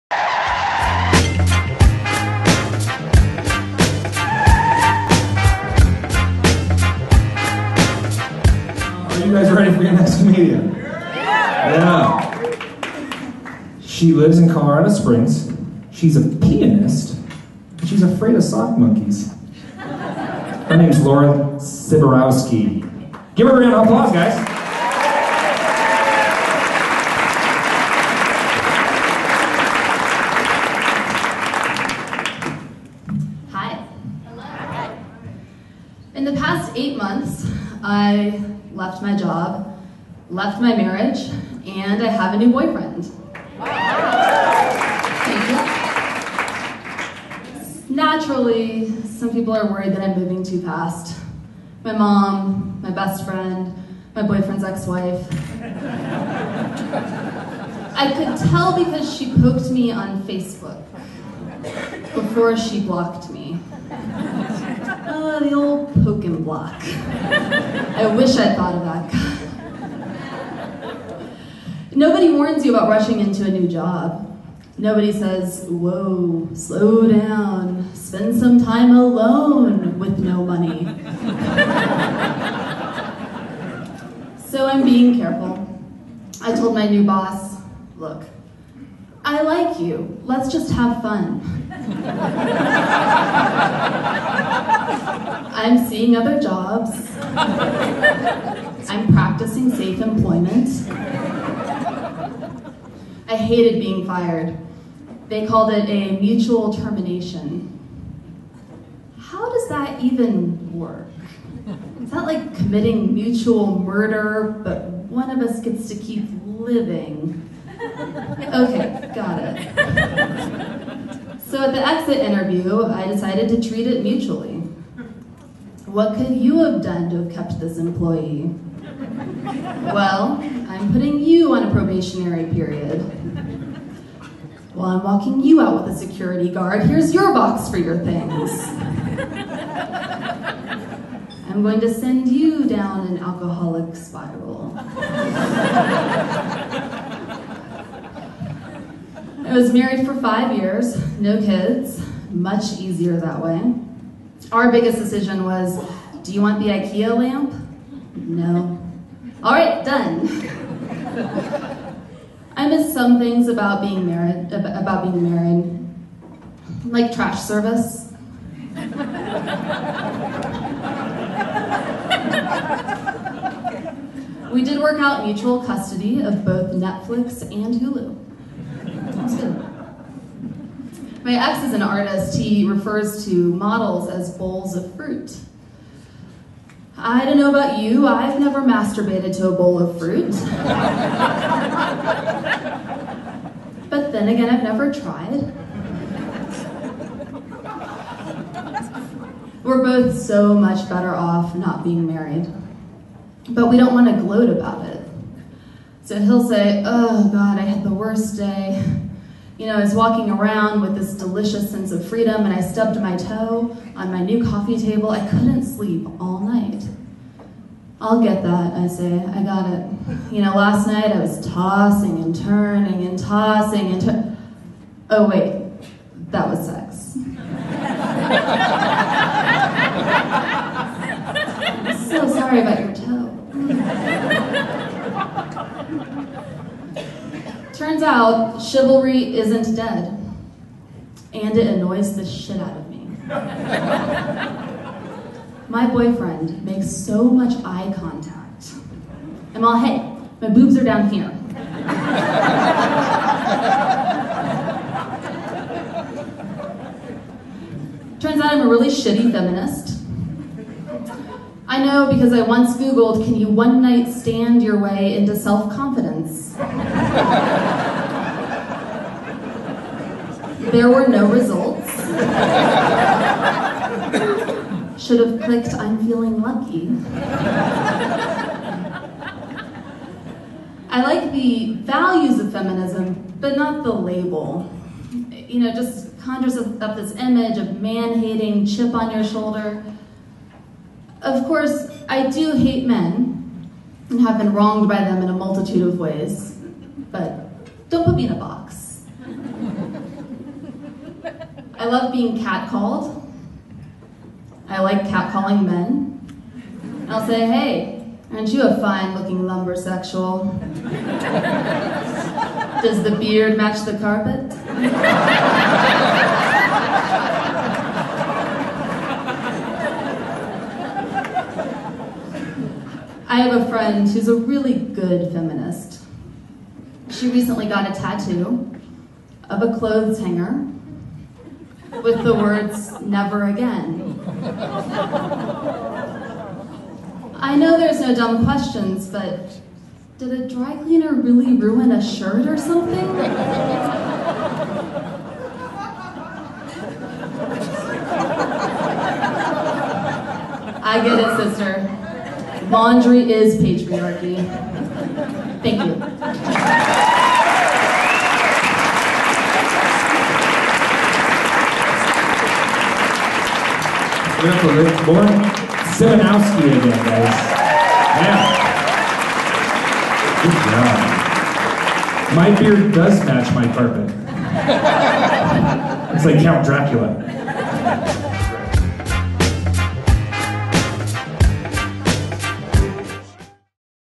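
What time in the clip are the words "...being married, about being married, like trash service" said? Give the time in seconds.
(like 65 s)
163 s.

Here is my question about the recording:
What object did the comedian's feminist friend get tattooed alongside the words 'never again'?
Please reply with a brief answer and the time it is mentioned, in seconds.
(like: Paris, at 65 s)
clothes hanger, at 329 s.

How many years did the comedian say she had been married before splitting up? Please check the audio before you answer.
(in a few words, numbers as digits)
5.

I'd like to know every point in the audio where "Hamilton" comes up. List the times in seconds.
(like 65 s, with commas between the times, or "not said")
not said.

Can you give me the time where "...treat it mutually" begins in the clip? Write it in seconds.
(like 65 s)
123 s.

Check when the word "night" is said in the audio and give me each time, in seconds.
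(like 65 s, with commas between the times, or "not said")
216 s, 220 s, 263 s.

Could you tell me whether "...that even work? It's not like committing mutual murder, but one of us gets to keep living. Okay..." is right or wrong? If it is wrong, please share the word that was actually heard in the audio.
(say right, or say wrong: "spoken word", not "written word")
right.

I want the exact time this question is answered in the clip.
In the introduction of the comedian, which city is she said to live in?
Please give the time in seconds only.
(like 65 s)
14 s.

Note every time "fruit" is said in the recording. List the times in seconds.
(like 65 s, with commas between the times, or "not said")
184 s, 189 s.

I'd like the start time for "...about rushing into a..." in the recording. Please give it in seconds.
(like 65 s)
72 s.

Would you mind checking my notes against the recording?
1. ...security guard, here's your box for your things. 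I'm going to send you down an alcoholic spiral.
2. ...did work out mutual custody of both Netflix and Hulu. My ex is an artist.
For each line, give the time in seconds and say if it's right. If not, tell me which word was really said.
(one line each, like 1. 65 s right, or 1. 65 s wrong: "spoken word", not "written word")
1. 135 s right
2. 174 s right.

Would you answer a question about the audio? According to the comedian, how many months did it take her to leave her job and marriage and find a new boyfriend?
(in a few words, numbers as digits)
8.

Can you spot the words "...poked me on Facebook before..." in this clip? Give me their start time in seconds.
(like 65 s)
59 s.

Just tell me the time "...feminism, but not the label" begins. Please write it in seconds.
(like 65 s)
282 s.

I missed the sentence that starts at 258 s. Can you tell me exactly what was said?
turns out I'm a really shitty feminist.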